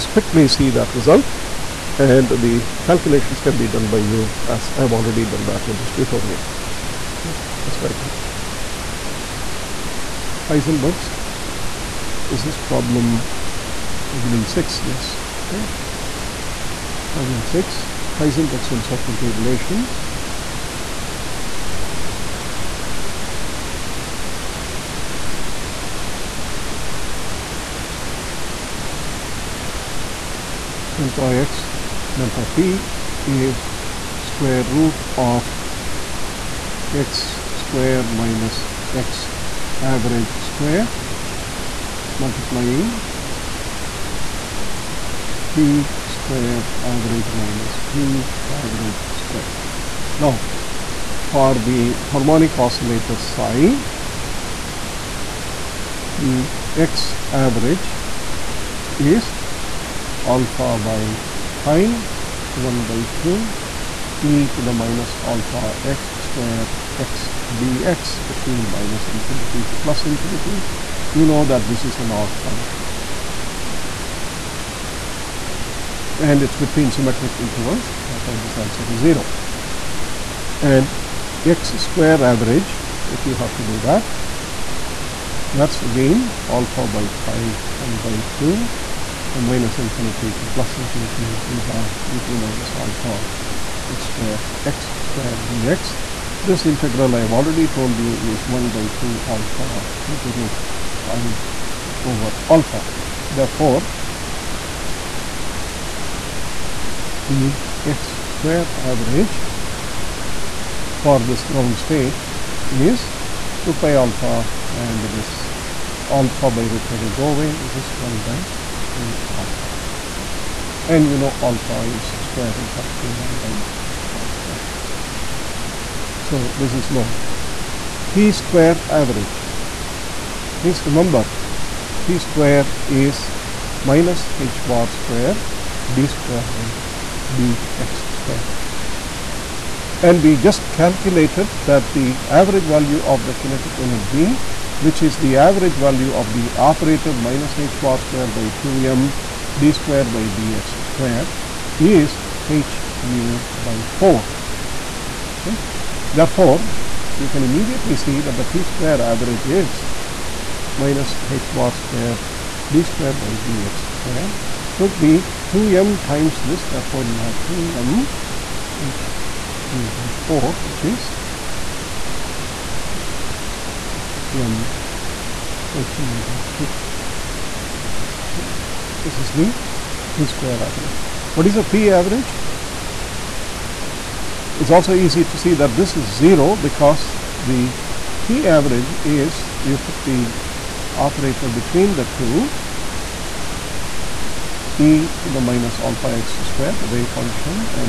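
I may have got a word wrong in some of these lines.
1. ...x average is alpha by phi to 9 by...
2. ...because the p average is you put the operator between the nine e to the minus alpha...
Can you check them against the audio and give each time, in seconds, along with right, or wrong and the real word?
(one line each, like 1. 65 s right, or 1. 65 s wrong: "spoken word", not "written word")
1. 56 s wrong: "1", not "9"
2. 186 s wrong: "two", not "nine".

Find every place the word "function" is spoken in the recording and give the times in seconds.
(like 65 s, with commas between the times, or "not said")
72 s, 197 s.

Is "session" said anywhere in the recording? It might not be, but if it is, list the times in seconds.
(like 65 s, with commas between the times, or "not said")
not said.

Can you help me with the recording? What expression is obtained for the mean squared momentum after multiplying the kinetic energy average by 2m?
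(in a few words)
m h nu / 2.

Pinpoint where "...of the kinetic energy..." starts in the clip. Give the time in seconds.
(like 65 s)
143 s.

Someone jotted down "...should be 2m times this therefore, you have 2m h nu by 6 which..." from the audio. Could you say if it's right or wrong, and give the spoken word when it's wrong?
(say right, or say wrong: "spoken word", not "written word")
wrong: "4", not "6".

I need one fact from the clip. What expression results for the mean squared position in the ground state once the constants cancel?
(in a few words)
1/(2 alpha).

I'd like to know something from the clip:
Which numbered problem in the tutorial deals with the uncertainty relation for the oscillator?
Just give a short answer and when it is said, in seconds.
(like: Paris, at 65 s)
6, at 17 s.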